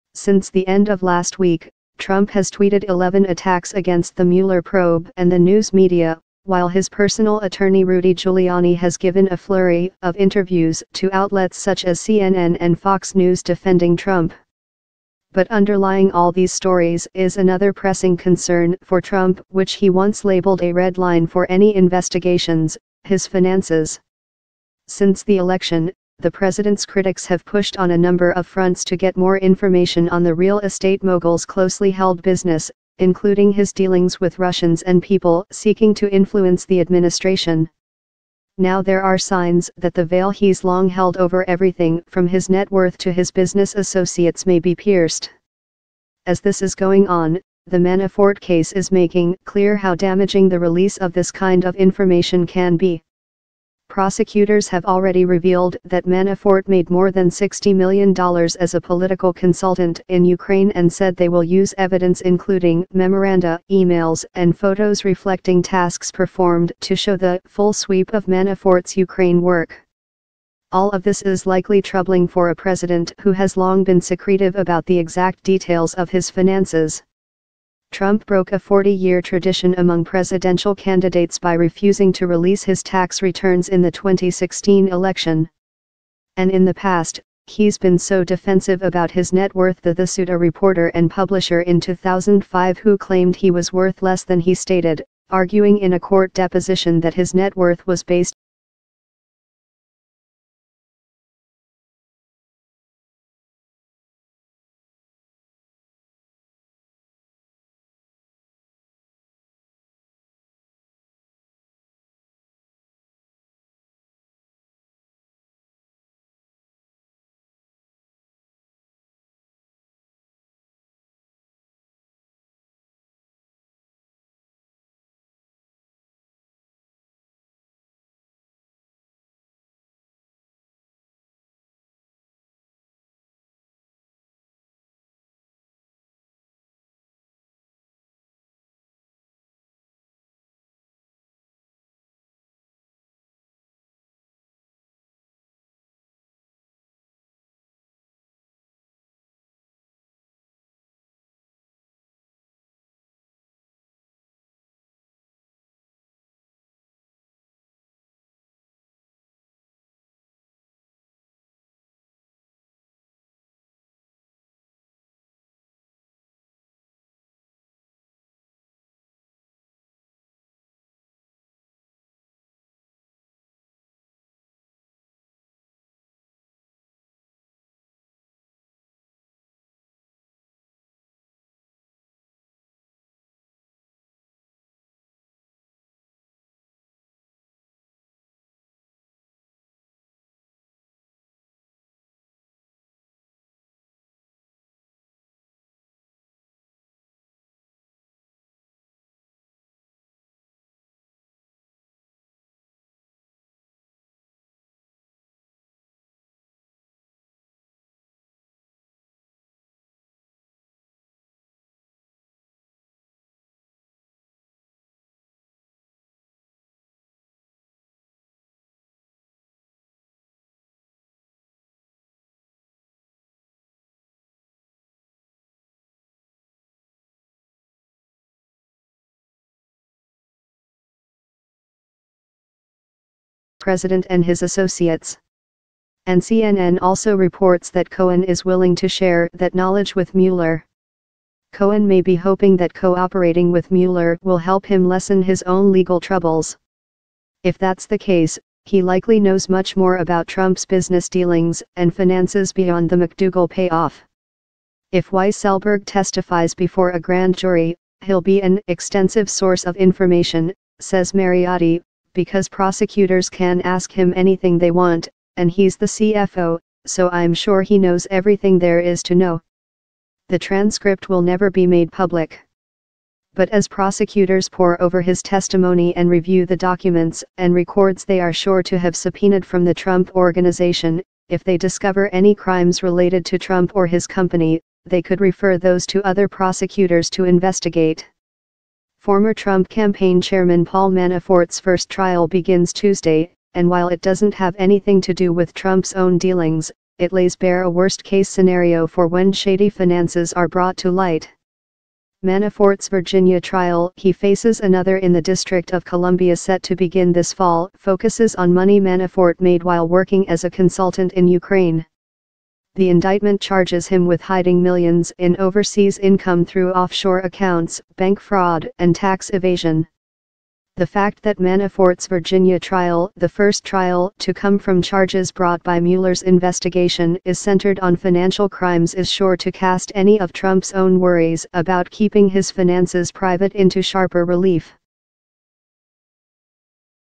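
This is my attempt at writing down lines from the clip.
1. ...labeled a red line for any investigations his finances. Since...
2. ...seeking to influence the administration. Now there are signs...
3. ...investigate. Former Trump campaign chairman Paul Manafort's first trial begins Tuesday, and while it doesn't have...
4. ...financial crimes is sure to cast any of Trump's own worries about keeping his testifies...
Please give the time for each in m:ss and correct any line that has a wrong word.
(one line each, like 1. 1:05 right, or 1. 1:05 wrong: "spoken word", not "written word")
1. 0:20 right
2. 0:35 right
3. 4:47 right
4. 5:27 wrong: "finances", not "testifies".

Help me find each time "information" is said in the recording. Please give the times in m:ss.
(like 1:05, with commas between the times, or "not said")
0:29, 0:51, 4:19.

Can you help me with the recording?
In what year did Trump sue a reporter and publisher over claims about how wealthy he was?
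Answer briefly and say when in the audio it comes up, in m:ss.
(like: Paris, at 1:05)
2005, at 1:31.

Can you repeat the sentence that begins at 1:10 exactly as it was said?
All of this is likely troubling for a president who has long been secretive about the exact details of his finances.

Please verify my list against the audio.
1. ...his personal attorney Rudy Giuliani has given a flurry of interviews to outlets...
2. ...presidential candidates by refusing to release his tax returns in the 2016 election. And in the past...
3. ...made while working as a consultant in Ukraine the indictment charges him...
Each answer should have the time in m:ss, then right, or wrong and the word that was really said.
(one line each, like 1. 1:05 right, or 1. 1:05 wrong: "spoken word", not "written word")
1. 0:06 right
2. 1:20 right
3. 5:09 right.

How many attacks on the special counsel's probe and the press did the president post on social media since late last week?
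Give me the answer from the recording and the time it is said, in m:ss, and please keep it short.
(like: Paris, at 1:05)
11, at 0:02.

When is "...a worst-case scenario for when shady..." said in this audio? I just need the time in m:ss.
4:57.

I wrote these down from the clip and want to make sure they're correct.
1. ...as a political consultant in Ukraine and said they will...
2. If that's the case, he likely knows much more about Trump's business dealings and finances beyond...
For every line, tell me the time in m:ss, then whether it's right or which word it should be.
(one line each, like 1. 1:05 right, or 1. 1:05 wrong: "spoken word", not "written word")
1. 0:58 right
2. 4:07 right.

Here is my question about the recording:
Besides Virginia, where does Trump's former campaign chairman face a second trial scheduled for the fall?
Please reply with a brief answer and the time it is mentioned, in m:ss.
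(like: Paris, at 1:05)
District of Columbia, at 5:05.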